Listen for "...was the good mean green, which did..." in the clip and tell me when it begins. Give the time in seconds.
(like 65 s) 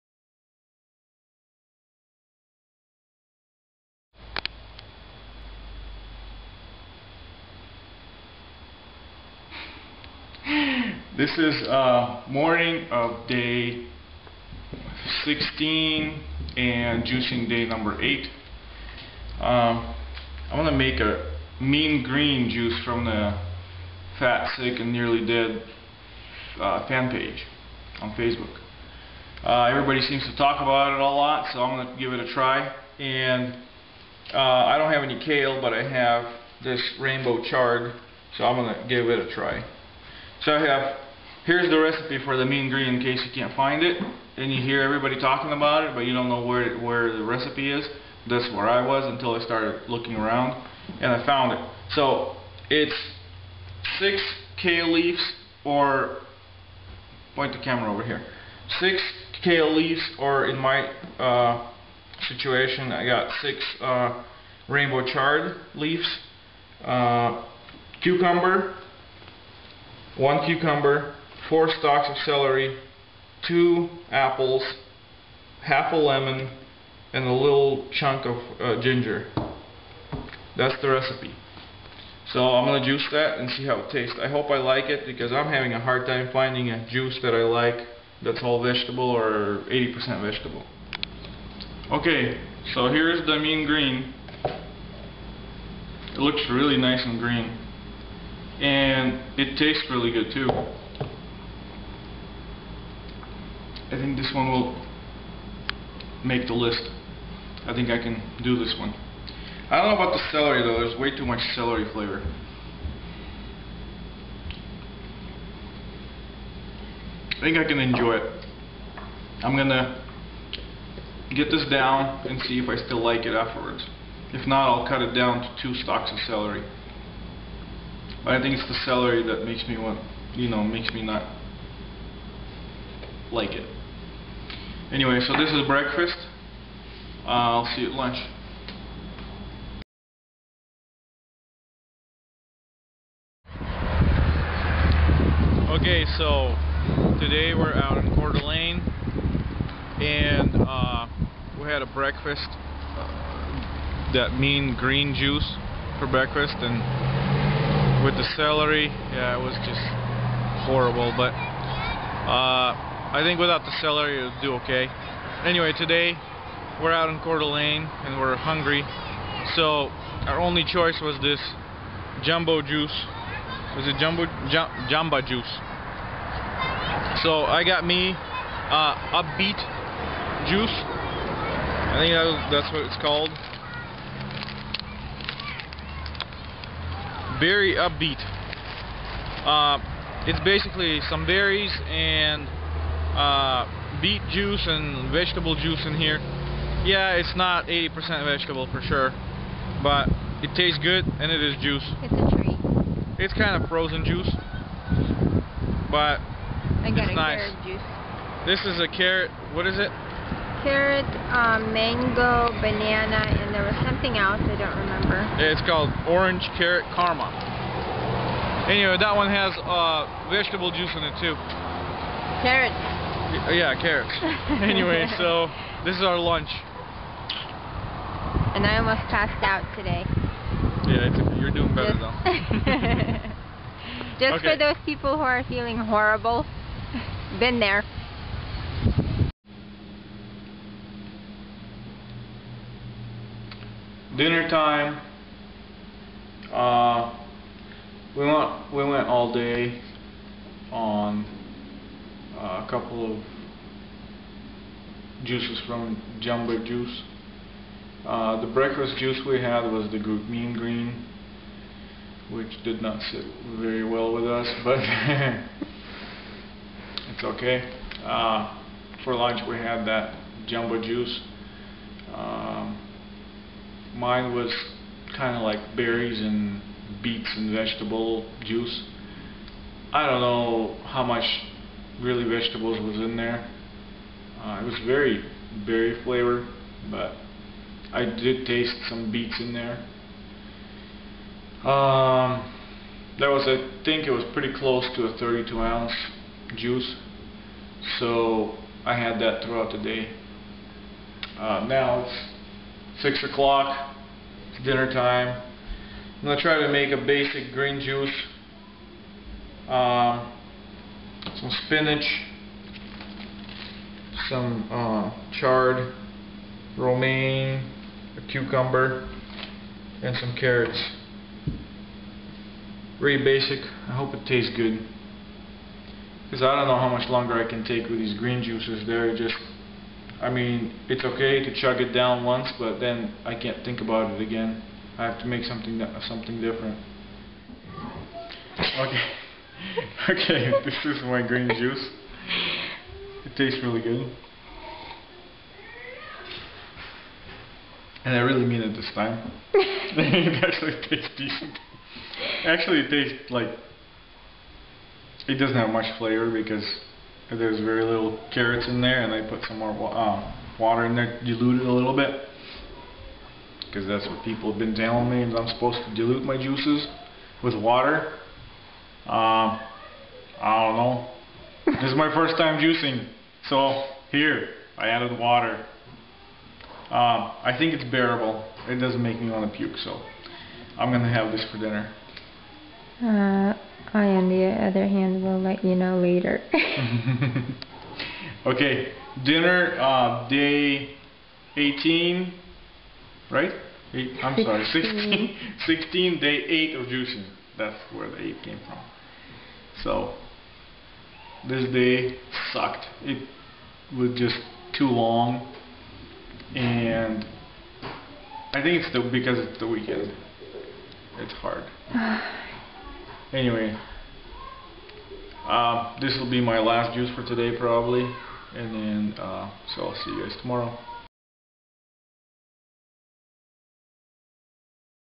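259 s.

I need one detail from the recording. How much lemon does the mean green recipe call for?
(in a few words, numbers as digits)
Half a lemon.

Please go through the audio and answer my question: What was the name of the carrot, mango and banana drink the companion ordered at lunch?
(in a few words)
Orange carrot karma.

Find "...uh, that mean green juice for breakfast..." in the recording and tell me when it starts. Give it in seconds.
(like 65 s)
152 s.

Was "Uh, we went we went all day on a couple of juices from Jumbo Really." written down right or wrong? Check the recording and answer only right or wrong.
wrong.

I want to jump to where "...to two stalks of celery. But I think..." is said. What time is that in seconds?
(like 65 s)
125 s.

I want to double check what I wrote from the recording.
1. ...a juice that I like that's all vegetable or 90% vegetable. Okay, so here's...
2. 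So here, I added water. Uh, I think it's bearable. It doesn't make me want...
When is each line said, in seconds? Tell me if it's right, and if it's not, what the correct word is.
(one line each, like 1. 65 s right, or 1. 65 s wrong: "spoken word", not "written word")
1. 86 s wrong: "80", not "90"
2. 373 s right.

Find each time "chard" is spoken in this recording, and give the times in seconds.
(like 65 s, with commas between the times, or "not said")
37 s, 65 s, 315 s.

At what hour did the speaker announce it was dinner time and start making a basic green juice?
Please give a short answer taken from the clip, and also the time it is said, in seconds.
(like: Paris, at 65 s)
6 o'clock, at 303 s.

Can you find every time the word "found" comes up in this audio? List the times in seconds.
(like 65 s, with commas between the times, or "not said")
51 s.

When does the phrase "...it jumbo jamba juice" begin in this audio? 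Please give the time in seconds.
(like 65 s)
173 s.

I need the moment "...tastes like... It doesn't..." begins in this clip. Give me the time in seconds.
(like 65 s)
352 s.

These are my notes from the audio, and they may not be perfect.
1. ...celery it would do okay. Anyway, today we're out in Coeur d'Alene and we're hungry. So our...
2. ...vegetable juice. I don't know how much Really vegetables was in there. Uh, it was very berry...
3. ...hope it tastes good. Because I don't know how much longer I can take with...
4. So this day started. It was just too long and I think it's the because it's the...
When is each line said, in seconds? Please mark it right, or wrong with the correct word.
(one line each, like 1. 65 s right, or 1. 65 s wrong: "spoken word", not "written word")
1. 163 s right
2. 277 s right
3. 323 s right
4. 399 s wrong: "sucked", not "started".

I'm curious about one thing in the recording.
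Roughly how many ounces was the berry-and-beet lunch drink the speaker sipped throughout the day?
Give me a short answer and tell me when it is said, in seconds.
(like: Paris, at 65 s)
32 ounces, at 295 s.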